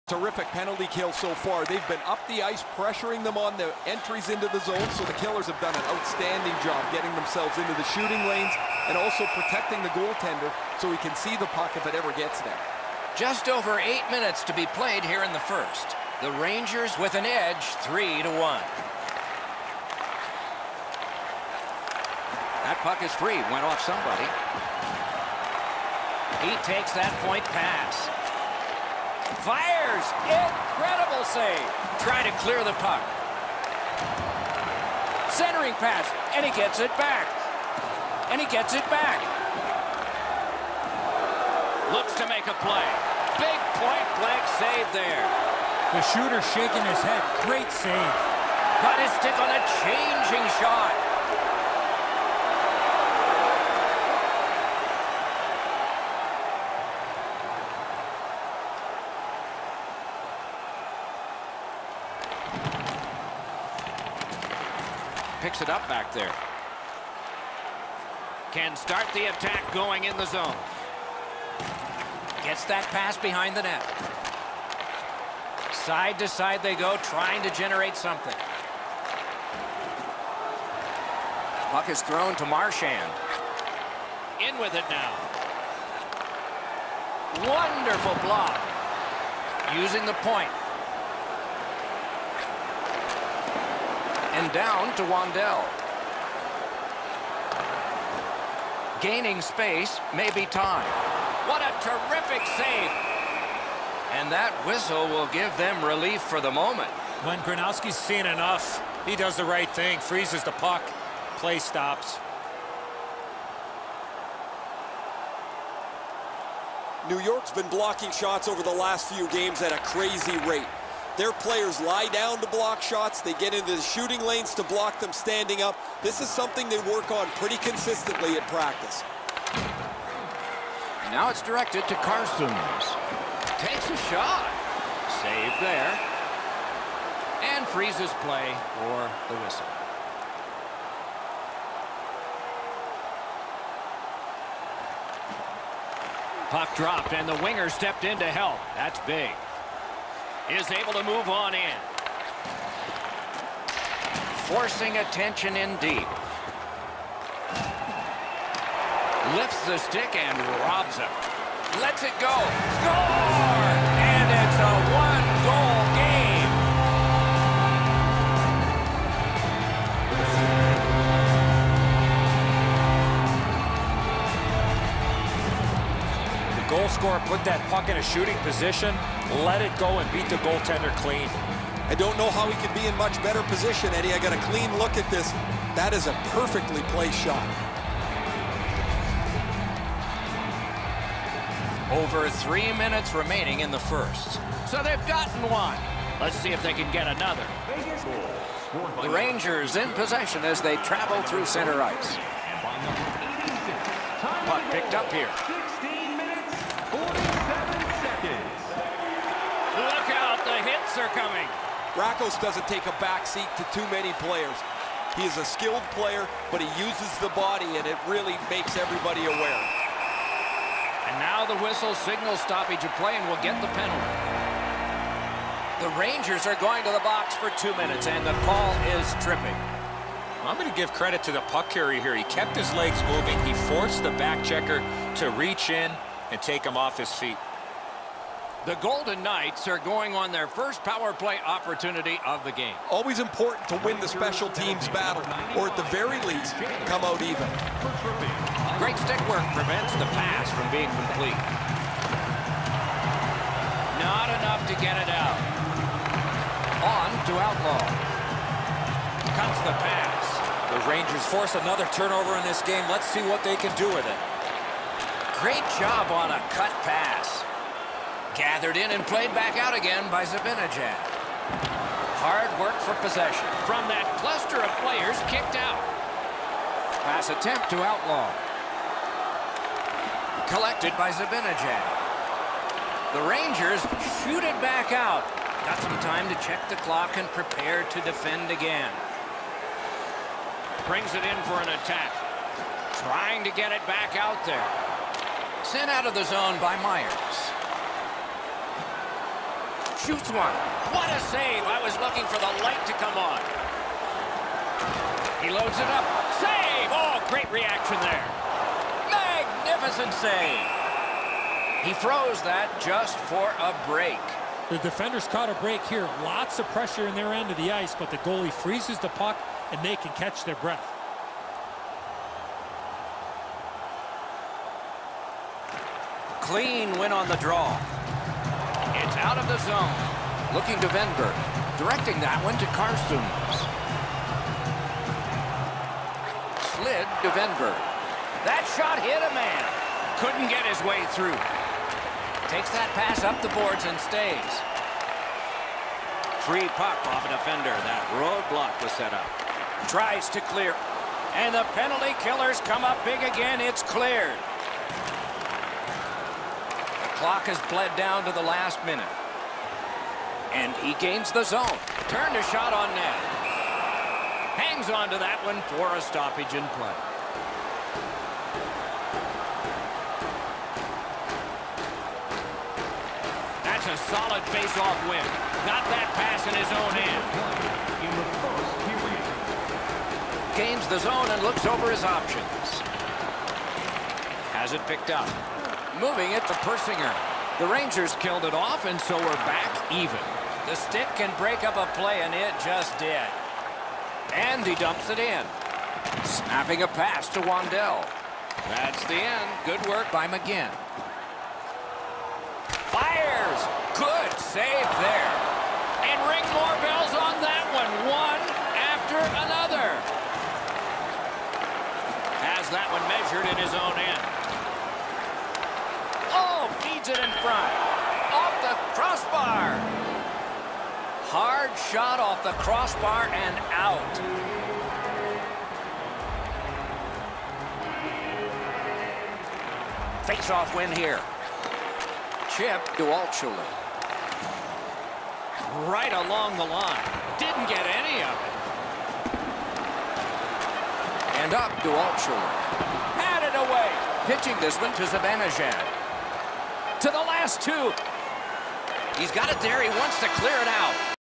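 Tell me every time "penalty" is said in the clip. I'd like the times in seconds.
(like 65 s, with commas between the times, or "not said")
0 s, 223 s, 351 s.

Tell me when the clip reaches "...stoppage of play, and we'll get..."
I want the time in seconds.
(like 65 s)
222 s.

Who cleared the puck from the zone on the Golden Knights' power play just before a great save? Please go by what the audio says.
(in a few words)
Myers.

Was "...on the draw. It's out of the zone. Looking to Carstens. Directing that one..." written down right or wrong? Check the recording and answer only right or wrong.
wrong.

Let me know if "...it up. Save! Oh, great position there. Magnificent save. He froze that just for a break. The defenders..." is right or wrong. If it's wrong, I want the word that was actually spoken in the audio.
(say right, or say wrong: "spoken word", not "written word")
wrong: "reaction", not "position".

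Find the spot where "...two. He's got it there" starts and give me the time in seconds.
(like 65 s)
447 s.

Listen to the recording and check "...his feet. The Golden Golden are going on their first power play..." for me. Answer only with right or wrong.
wrong.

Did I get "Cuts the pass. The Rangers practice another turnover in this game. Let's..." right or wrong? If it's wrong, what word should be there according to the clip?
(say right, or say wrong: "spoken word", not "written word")
wrong: "force", not "practice".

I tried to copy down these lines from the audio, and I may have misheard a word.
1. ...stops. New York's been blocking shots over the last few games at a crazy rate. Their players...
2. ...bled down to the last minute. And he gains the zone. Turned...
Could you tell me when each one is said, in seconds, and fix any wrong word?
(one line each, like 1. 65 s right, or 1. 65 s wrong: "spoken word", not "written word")
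1. 111 s right
2. 357 s right.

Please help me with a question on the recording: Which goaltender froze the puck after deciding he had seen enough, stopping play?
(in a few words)
Gronowski.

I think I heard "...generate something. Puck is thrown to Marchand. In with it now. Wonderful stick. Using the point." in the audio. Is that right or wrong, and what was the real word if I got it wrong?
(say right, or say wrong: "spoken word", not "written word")
wrong: "block", not "stick".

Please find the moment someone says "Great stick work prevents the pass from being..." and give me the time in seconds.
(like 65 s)
248 s.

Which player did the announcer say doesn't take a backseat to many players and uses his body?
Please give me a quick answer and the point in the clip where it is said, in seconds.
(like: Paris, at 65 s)
Rakos, at 211 s.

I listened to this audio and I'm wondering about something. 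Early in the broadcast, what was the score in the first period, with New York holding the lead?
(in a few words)
3 to 1.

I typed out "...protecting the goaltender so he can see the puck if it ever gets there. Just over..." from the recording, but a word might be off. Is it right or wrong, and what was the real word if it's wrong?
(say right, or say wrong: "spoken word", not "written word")
right.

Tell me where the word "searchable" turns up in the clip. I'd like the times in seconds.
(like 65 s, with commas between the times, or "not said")
not said.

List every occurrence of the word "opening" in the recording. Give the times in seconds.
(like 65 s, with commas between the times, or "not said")
not said.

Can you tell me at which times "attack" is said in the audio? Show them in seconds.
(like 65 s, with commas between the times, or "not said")
69 s, 291 s.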